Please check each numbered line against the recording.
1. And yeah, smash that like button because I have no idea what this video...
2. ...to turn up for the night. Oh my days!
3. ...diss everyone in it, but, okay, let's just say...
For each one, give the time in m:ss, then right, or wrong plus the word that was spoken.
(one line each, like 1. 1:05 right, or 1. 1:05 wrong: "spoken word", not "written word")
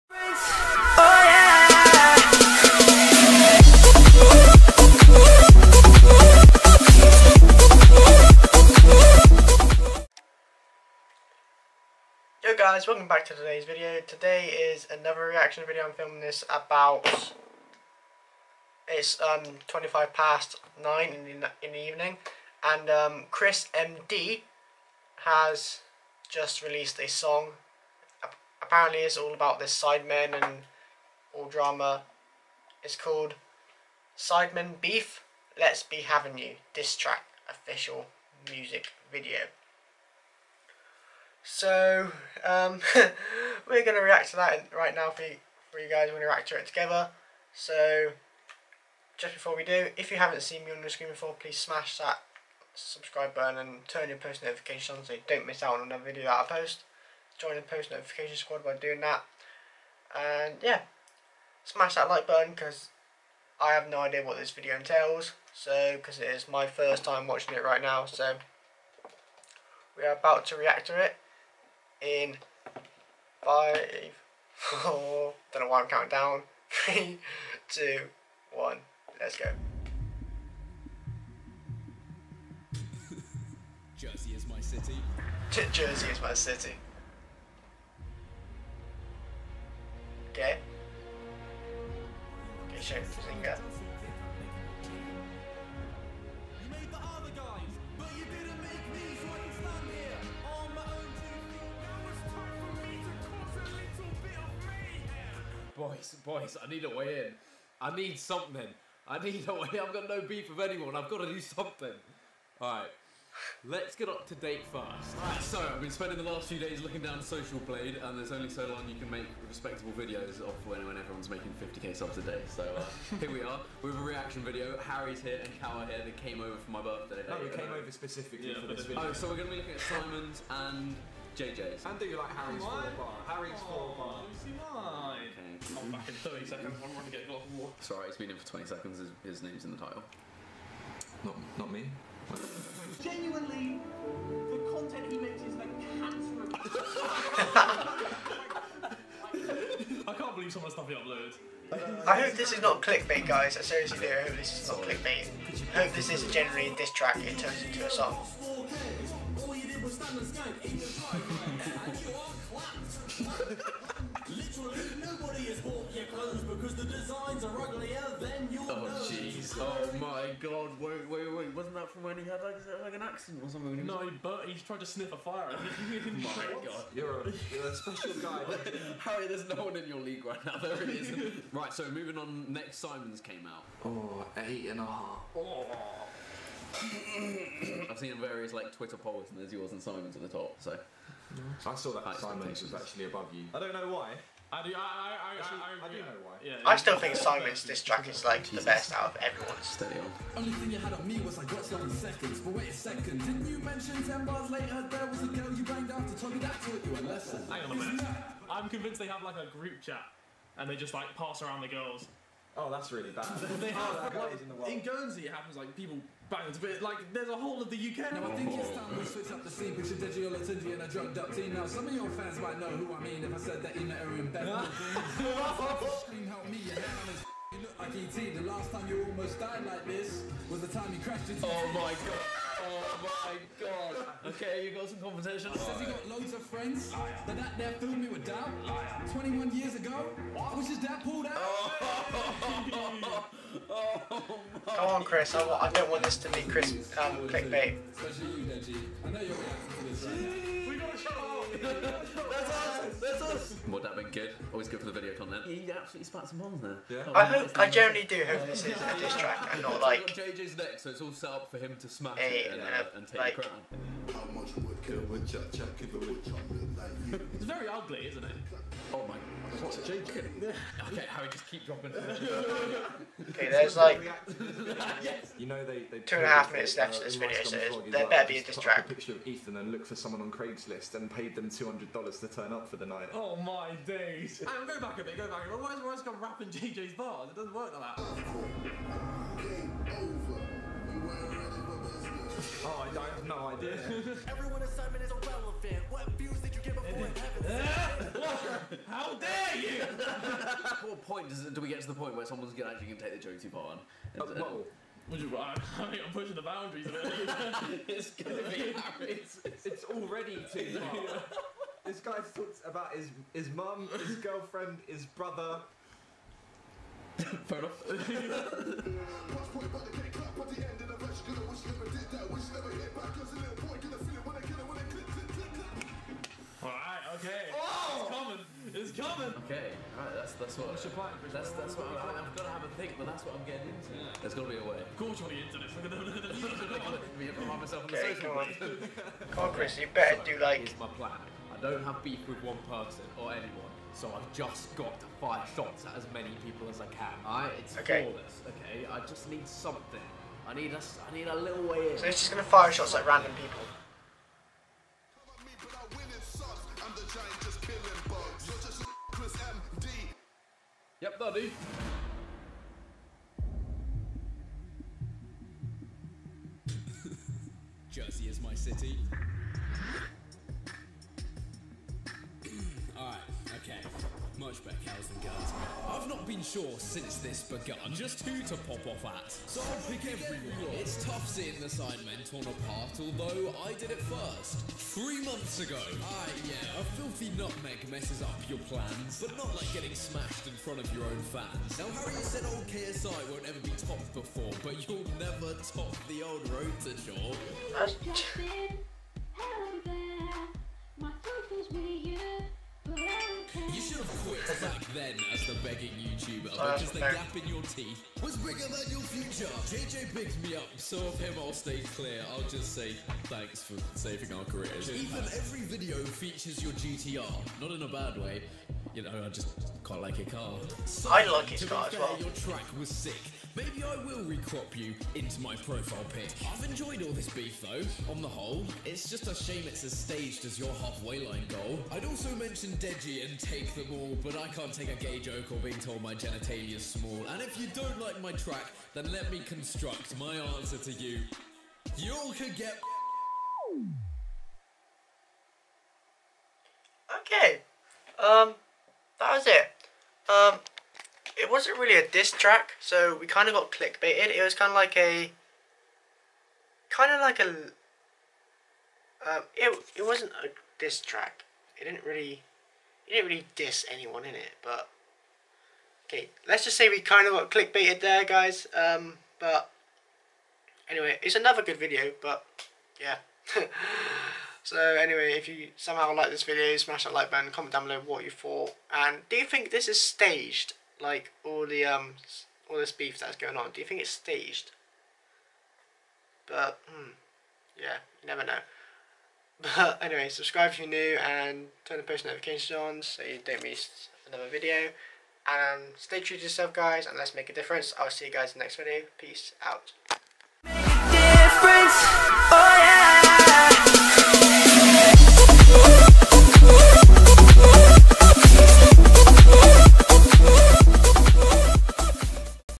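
1. 1:00 right
2. 4:42 right
3. 7:43 wrong: "anyone", not "everyone".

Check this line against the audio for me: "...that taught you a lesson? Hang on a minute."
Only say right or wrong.
right.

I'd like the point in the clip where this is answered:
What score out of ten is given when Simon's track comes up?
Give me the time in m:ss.
3:04.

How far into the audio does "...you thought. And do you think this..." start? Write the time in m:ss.
7:58.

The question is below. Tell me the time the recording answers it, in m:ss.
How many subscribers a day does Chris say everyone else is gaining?
2:01.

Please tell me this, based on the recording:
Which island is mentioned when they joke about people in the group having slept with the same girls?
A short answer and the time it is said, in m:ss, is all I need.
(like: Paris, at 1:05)
Guernsey, at 3:34.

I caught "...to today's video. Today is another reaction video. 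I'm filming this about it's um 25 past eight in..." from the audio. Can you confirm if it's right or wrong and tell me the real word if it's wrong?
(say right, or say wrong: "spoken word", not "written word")
wrong: "nine", not "eight".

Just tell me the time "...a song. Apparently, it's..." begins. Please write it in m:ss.
0:26.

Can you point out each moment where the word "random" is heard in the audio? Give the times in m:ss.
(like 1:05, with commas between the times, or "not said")
5:53.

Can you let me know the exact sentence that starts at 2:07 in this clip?
No, we came over specifically yeah, for this video.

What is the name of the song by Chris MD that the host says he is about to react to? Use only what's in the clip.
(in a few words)
Sidemen Beef.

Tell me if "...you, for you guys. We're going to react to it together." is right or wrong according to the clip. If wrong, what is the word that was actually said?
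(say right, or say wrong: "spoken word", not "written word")
right.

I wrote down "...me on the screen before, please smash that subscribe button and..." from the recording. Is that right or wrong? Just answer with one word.
right.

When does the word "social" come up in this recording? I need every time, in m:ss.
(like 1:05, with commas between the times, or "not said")
1:57, 5:37.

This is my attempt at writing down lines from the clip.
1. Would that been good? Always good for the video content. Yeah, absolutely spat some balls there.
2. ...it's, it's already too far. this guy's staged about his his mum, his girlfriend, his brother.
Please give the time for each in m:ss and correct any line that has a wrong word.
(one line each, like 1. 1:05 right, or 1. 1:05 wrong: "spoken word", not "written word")
1. 4:13 right
2. 5:09 wrong: "talked", not "staged".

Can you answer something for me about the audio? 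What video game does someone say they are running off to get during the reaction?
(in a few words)
God of War.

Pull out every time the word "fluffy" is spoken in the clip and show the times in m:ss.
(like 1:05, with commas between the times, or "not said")
not said.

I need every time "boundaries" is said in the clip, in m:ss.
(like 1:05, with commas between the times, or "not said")
5:06.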